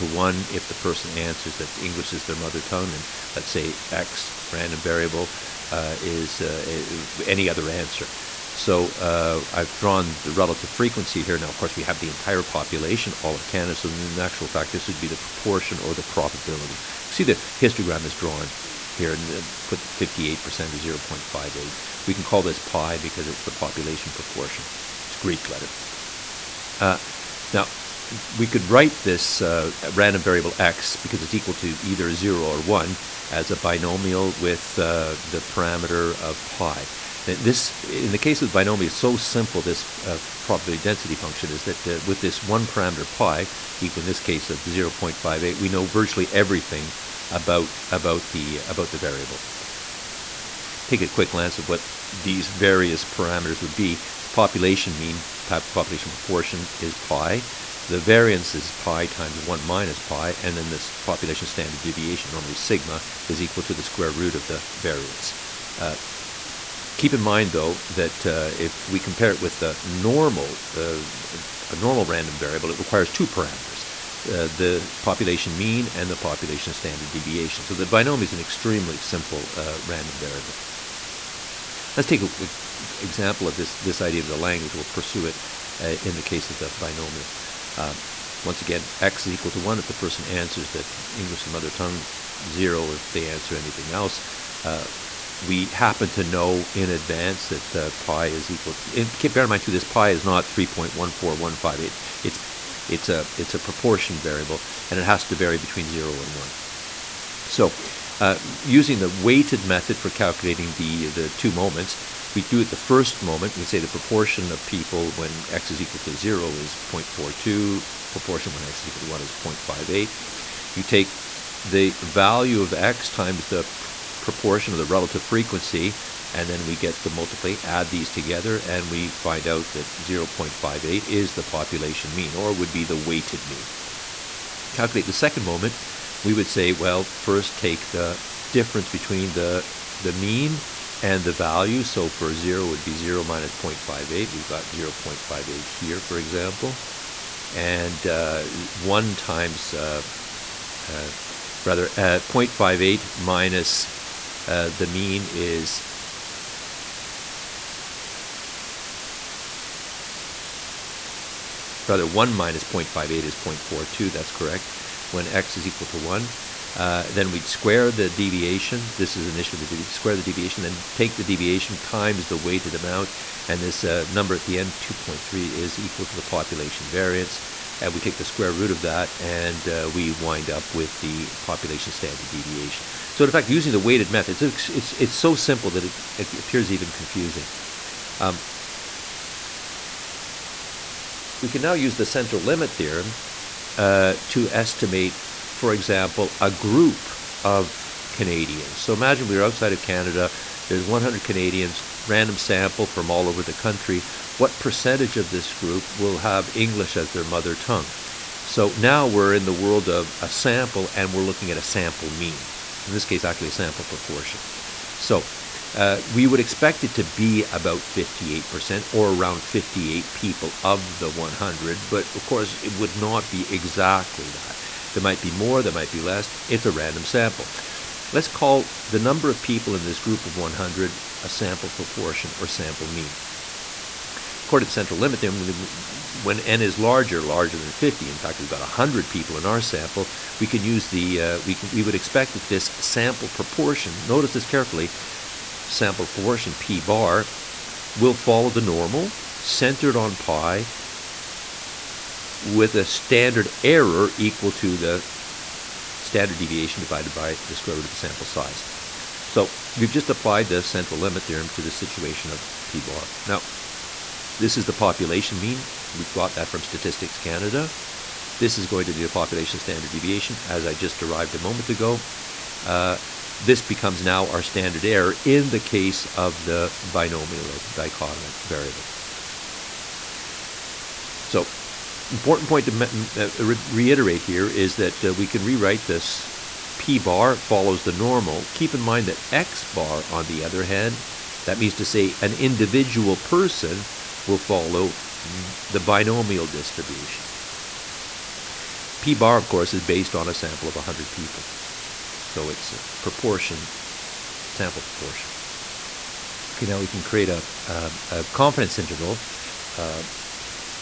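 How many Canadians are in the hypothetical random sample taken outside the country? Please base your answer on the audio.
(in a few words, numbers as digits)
100.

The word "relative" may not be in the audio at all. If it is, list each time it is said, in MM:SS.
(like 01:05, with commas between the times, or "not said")
00:10, 02:04.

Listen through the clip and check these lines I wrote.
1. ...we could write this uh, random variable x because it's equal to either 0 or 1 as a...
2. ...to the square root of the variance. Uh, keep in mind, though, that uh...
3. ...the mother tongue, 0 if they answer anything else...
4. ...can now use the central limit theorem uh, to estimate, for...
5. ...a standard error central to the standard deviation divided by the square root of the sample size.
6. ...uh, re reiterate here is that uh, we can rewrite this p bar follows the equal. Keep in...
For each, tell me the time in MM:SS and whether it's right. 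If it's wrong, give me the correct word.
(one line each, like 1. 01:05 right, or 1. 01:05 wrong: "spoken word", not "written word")
1. 00:28 right
2. 01:03 right
3. 01:31 right
4. 03:11 right
5. 04:12 wrong: "equal", not "central"
6. 04:43 wrong: "normal", not "equal".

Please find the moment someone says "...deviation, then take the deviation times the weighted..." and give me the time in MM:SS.
02:50.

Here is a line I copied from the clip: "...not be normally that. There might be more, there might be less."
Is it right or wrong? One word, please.
wrong.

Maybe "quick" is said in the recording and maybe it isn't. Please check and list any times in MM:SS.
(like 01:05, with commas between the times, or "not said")
00:51.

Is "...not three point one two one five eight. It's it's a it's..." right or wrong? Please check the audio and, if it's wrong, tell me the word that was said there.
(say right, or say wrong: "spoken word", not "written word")
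wrong: "four", not "two".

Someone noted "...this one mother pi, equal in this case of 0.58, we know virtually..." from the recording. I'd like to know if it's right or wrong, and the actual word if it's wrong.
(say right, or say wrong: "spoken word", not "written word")
wrong: "parameter", not "mother".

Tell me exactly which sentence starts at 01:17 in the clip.
So the binomial is an extremely simple uh, random variable.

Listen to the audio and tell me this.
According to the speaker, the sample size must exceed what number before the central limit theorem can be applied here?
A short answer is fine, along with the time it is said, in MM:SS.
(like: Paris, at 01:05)
50, at 03:57.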